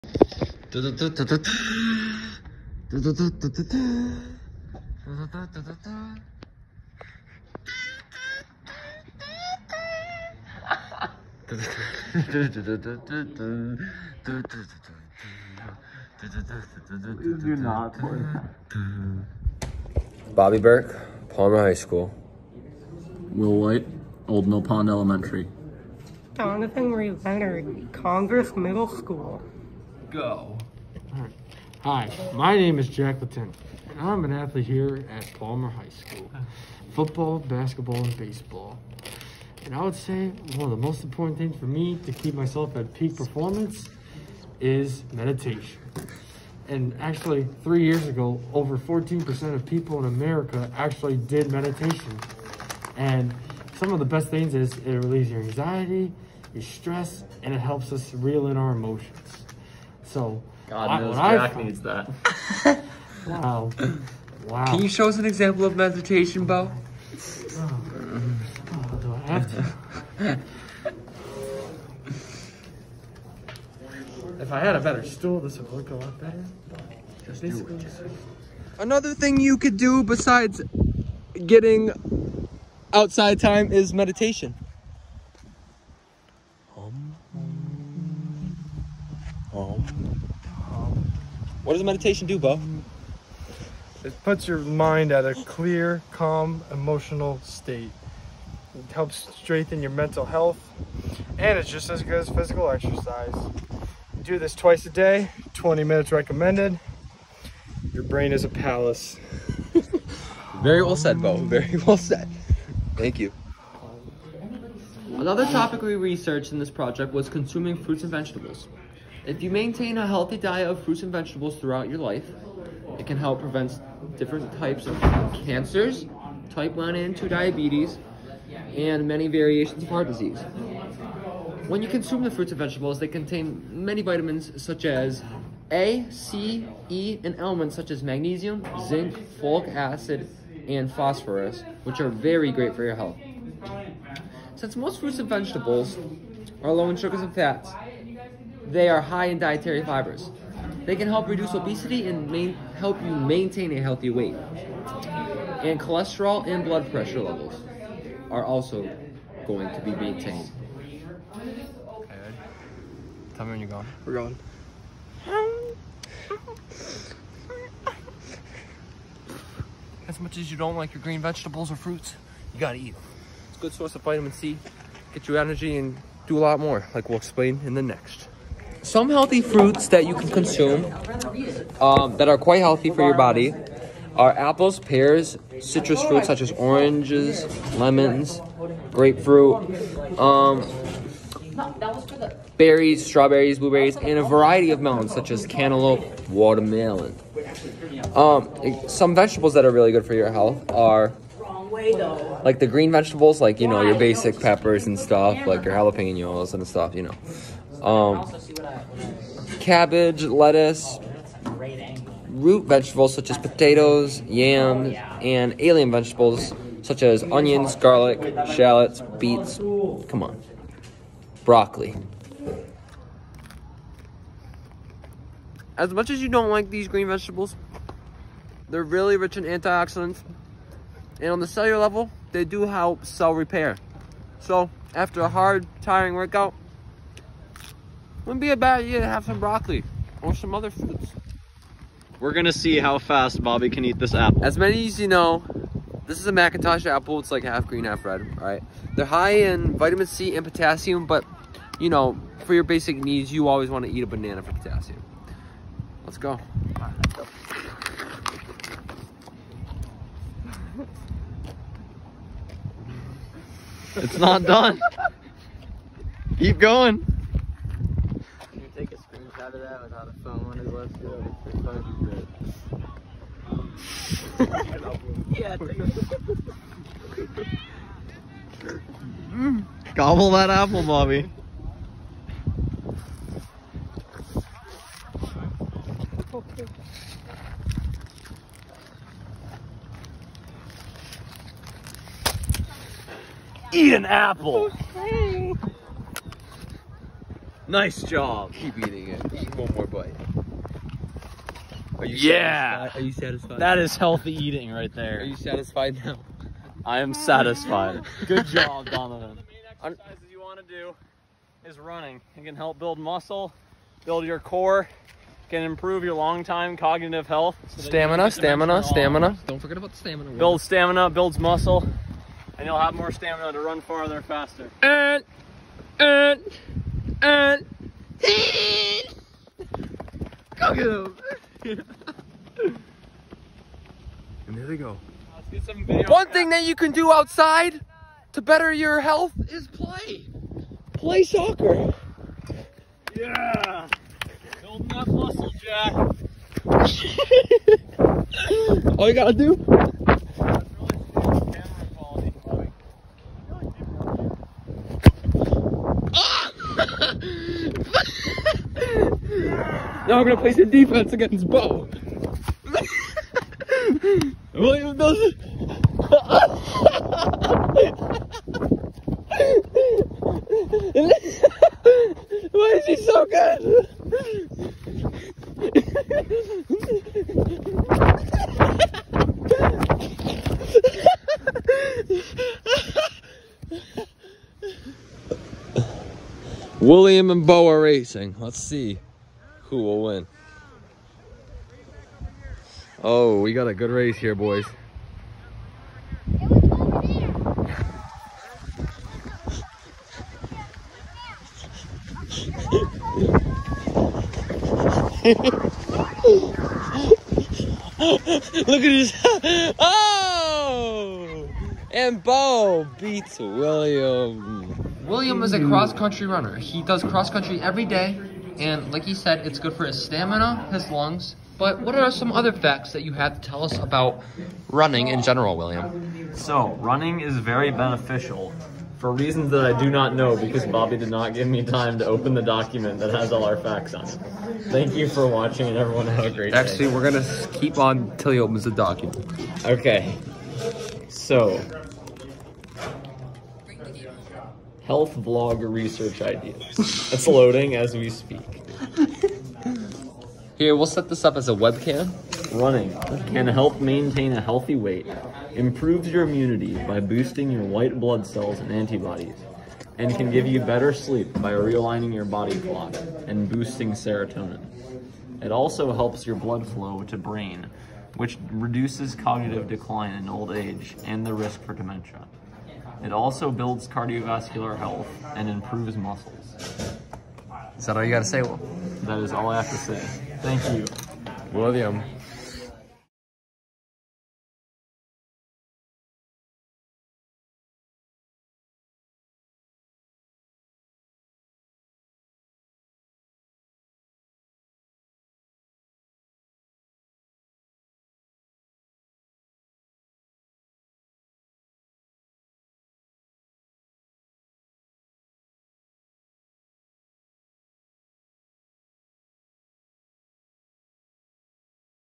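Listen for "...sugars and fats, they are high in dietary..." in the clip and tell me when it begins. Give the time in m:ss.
2:26.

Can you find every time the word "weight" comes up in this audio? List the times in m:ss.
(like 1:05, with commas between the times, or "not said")
2:34, 7:34.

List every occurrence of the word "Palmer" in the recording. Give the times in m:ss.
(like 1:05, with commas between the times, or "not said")
0:21, 0:35.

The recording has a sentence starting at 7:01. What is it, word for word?
But what are some other facts that you have to tell us about running in general, William?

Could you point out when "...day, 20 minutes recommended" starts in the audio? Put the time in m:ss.
1:44.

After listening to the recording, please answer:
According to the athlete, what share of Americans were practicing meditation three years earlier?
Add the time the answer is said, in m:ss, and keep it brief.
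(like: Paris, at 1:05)
14%, at 0:48.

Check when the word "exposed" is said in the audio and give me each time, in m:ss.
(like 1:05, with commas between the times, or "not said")
not said.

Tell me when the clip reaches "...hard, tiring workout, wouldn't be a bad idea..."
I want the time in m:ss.
3:55.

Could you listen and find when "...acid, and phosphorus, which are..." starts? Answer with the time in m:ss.
2:19.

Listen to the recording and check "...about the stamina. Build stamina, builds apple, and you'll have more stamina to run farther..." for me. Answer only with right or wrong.
wrong.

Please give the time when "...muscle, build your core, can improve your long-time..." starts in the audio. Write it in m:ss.
5:12.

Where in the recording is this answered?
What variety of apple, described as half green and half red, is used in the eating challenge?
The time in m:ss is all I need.
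4:06.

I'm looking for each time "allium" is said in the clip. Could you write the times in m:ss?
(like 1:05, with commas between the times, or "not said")
3:35.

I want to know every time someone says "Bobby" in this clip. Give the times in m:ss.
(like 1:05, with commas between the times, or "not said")
0:20, 4:03, 4:40, 7:10.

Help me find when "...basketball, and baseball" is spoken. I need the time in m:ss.
0:37.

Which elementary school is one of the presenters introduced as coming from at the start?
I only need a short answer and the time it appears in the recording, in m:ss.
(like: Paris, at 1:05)
Old Mill Pond Elementary, at 0:24.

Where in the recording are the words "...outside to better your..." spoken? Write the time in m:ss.
5:37.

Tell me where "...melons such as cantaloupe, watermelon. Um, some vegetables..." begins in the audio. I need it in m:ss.
3:14.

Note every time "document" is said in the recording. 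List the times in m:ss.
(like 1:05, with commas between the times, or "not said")
7:12, 7:18.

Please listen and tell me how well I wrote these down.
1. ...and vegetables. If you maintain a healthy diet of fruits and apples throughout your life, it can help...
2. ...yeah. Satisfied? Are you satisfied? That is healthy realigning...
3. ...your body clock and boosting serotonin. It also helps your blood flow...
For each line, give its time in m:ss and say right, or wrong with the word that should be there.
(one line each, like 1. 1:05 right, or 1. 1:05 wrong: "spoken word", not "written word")
1. 1:58 wrong: "vegetables", not "apples"
2. 5:02 wrong: "eating", not "realigning"
3. 7:42 right.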